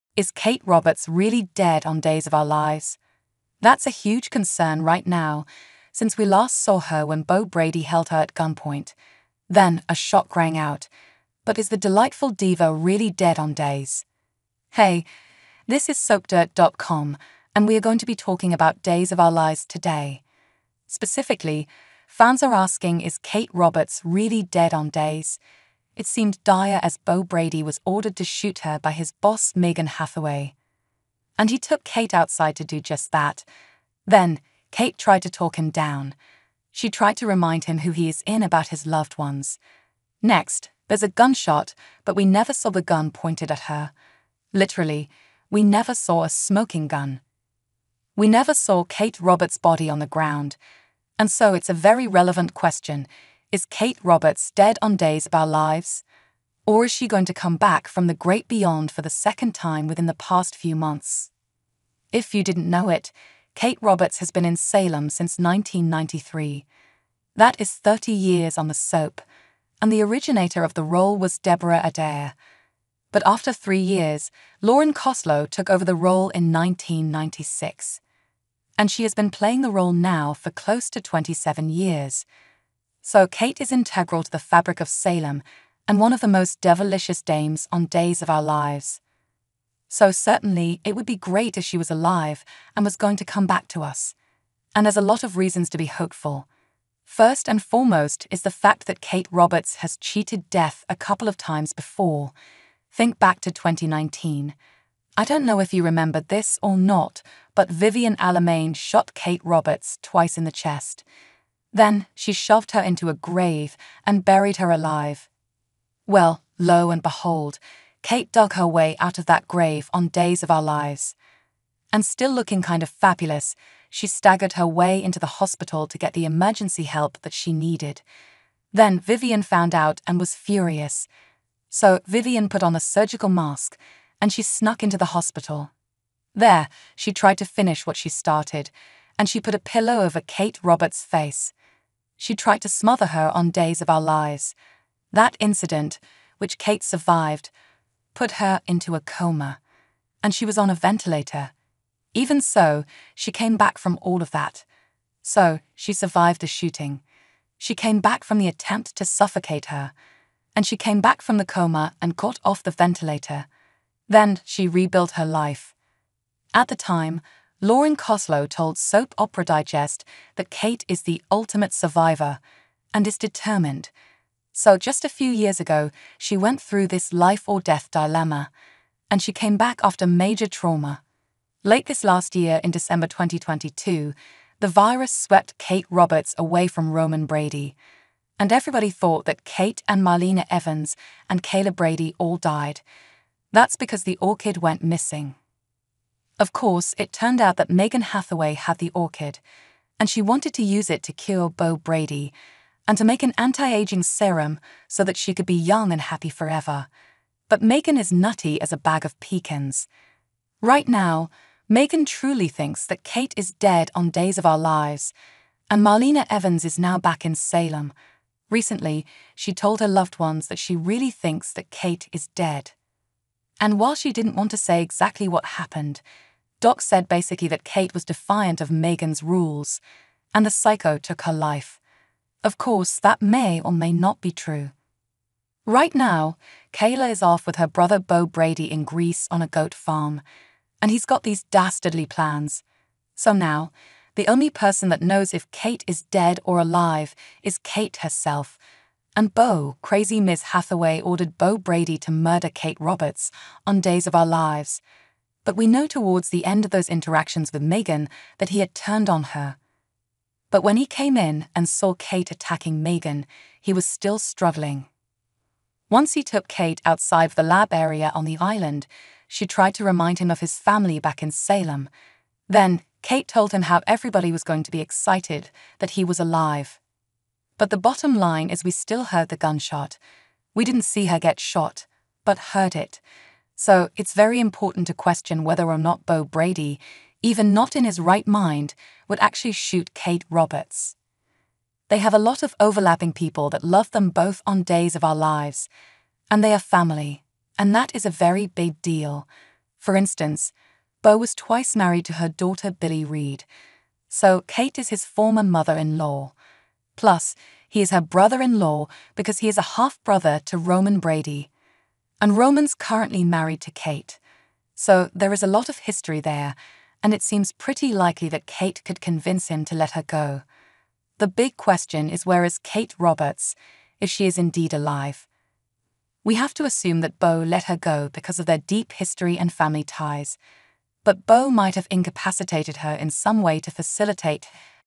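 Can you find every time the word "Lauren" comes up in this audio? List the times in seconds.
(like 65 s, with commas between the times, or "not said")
74 s, 167 s.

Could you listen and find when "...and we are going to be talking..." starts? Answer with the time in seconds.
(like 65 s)
17 s.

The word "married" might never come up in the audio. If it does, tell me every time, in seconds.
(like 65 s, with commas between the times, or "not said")
301 s, 313 s.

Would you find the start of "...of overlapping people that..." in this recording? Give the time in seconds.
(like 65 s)
292 s.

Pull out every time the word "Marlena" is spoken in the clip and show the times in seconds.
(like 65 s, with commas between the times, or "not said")
190 s, 215 s.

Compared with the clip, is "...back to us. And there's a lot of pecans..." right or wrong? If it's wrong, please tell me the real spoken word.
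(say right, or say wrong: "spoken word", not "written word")
wrong: "reasons", not "pecans".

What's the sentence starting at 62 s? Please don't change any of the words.
If you didn't know it, Kate Roberts has been in Salem since 1993.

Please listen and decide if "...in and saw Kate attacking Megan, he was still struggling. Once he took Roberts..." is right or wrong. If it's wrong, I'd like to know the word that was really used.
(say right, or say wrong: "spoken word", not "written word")
wrong: "Kate", not "Roberts".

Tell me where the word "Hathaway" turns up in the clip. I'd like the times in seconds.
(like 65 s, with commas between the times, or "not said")
29 s, 198 s, 250 s.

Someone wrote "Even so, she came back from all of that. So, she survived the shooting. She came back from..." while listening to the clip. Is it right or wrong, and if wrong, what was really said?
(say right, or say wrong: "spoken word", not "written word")
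right.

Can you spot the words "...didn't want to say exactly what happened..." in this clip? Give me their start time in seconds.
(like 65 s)
224 s.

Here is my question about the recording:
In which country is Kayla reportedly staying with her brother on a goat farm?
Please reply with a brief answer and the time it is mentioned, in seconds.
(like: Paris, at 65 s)
Greece, at 238 s.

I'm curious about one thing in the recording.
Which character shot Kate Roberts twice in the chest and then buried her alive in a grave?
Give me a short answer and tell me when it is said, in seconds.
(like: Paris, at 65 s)
Vivian Alamain, at 107 s.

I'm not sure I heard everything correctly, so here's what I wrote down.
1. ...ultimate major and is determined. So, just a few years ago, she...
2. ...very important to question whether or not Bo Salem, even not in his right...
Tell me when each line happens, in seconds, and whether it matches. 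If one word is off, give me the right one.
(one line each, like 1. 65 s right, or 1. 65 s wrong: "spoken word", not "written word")
1. 171 s wrong: "survivor", not "major"
2. 284 s wrong: "Brady", not "Salem".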